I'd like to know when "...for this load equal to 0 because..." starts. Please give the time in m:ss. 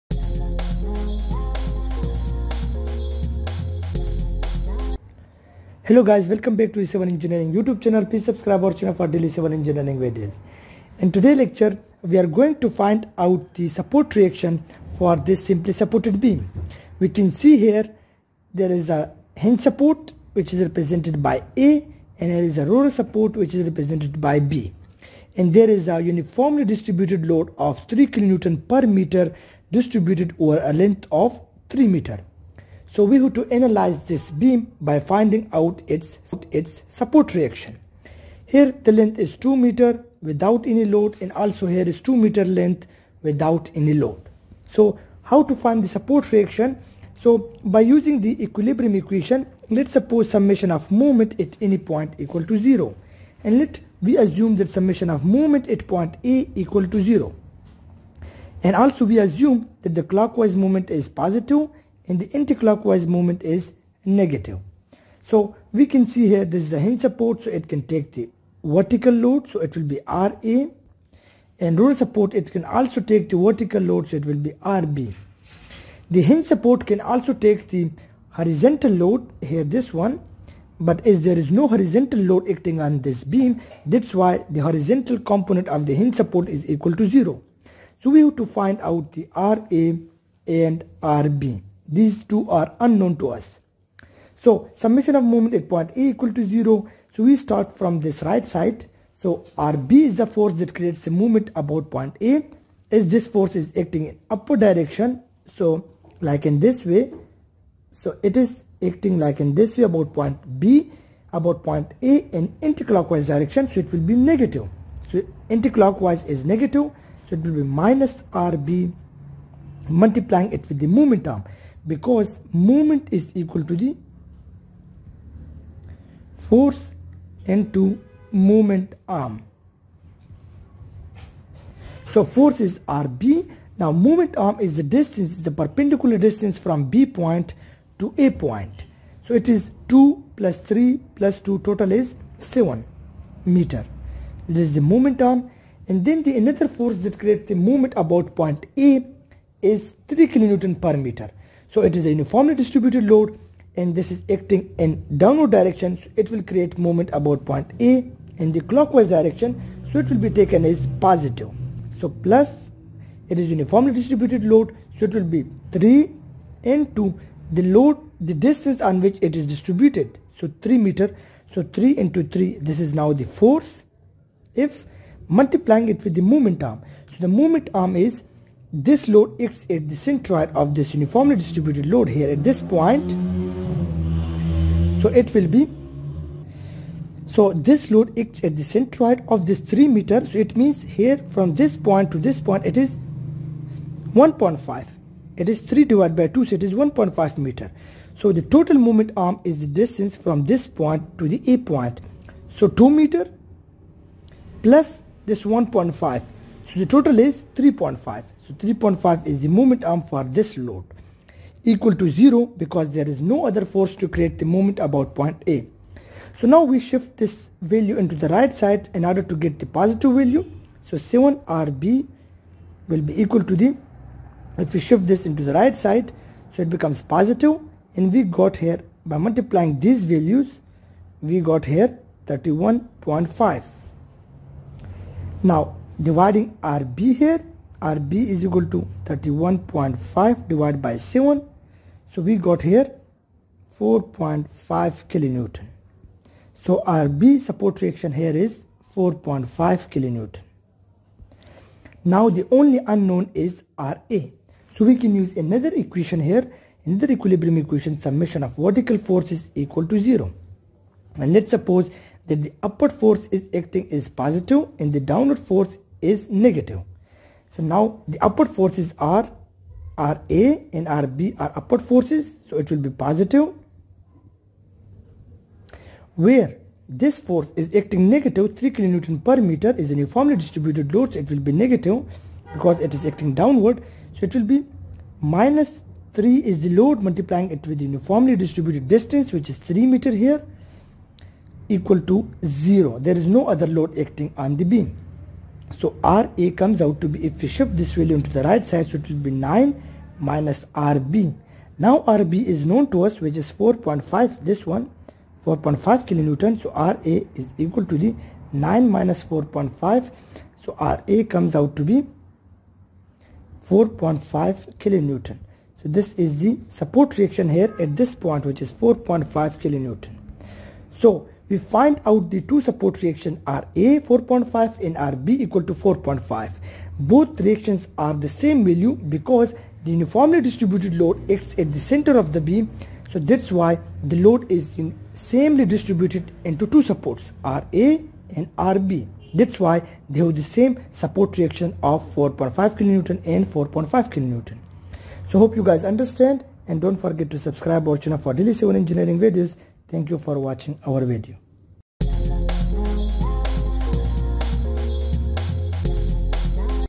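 3:30.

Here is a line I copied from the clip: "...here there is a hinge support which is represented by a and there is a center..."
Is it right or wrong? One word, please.
wrong.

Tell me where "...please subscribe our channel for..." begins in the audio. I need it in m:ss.
0:08.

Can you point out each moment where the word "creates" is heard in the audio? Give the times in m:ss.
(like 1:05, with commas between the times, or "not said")
1:40, 2:27, 2:36, 3:34.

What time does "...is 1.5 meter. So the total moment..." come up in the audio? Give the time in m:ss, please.
3:16.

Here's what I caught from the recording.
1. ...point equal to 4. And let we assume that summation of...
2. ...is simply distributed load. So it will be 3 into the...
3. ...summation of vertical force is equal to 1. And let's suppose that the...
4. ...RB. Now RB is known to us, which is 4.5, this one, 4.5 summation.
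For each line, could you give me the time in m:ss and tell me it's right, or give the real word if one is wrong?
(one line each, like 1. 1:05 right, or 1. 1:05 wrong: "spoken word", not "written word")
1. 0:51 wrong: "0", not "4"
2. 2:43 wrong: "uniformly", not "simply"
3. 4:17 wrong: "0", not "1"
4. 5:00 wrong: "kilonewton", not "summation".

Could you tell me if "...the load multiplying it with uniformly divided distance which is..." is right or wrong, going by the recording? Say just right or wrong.
wrong.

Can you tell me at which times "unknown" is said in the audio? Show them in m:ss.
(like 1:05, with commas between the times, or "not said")
1:32, 4:12.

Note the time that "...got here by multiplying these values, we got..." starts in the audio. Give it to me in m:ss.
3:48.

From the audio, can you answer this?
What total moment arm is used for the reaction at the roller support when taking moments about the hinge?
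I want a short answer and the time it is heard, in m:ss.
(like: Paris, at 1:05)
7 meter, at 2:22.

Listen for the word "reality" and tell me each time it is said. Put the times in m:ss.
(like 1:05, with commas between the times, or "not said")
not said.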